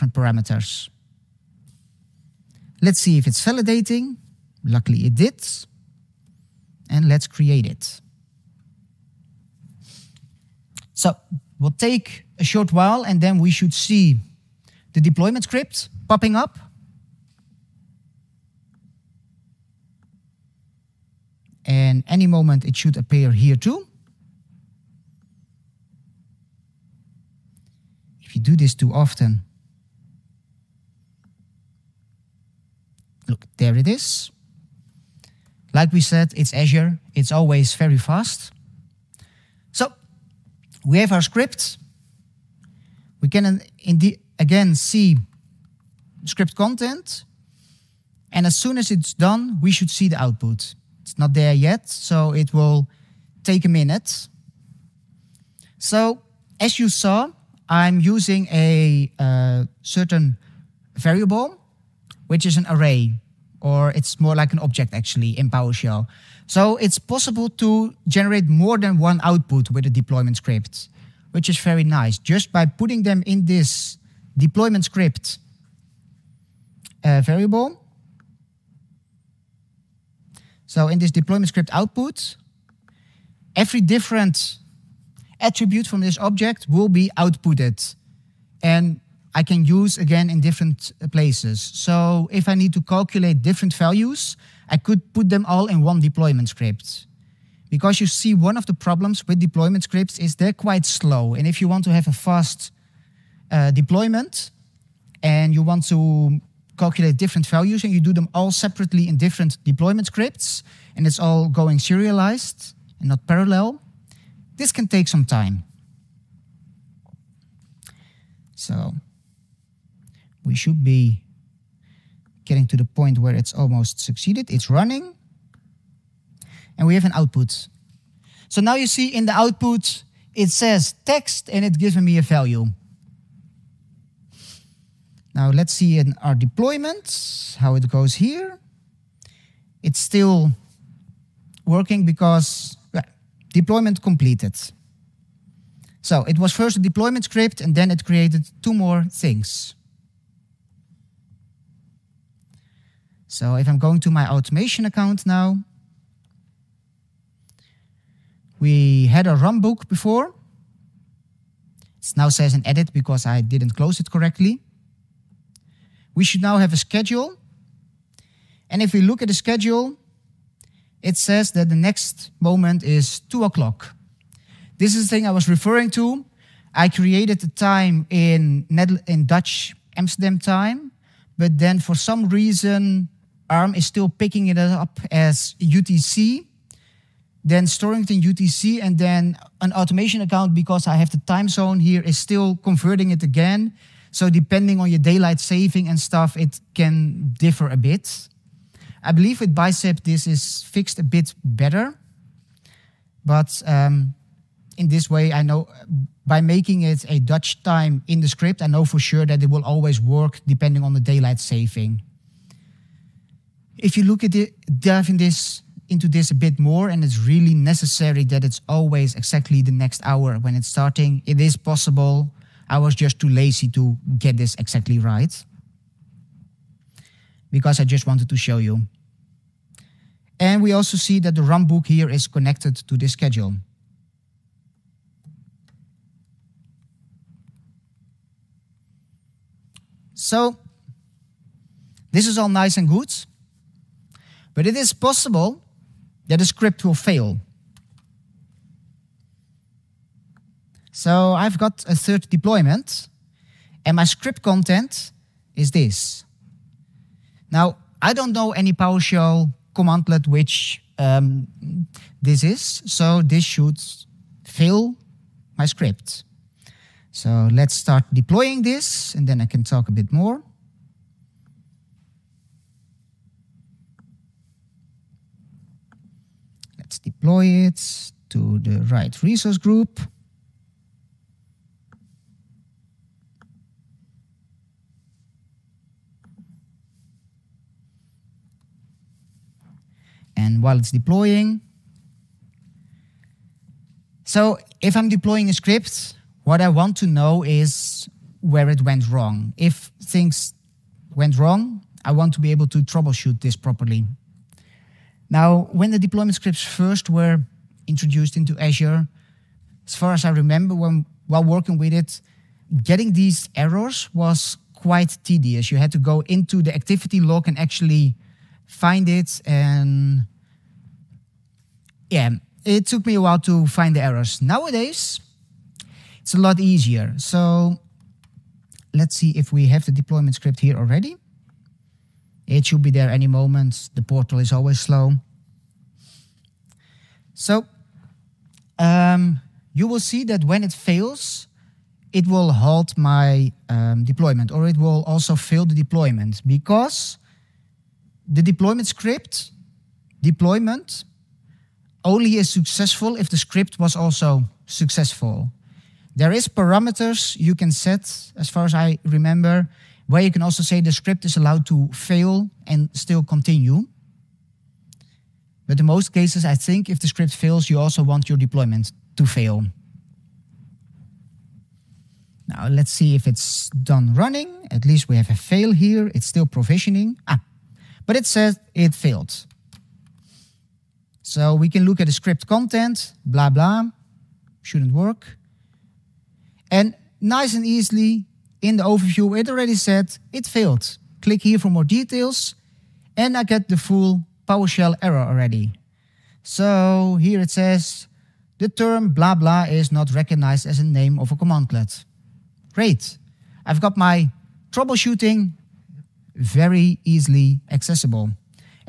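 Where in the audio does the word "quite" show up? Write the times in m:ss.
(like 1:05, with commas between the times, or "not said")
1:40, 5:14.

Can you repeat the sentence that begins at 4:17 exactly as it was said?
Now, I don't know any PowerShell commandlet which um, this is, so this should fill my script.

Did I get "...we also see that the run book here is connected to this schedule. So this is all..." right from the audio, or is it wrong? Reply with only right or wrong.
right.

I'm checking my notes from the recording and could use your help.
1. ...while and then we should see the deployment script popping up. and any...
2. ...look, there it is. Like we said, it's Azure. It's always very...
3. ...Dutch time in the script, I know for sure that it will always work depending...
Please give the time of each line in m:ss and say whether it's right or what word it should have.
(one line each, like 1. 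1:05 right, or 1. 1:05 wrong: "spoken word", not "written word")
1. 0:12 right
2. 0:33 right
3. 3:27 right.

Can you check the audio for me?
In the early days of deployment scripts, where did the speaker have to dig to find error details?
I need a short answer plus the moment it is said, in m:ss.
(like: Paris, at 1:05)
activity log, at 5:16.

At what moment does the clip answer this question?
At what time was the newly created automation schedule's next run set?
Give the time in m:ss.
2:53.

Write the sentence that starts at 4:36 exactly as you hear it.
Let's deploy it to the right resource group.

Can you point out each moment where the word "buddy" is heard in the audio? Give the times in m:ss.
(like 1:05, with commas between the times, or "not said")
not said.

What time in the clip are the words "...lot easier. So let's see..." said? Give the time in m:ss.
5:26.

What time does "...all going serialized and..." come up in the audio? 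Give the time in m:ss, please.
1:51.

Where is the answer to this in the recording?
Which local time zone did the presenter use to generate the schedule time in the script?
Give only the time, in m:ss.
2:59.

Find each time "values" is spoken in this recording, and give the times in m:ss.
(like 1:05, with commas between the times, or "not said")
1:33, 1:47, 2:12.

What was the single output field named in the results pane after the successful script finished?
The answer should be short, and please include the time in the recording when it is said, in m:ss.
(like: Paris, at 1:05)
text, at 2:11.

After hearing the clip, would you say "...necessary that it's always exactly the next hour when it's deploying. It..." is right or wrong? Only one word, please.
wrong.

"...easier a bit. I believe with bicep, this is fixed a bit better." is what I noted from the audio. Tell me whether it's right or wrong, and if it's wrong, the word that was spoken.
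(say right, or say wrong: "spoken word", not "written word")
wrong: "differ", not "easier".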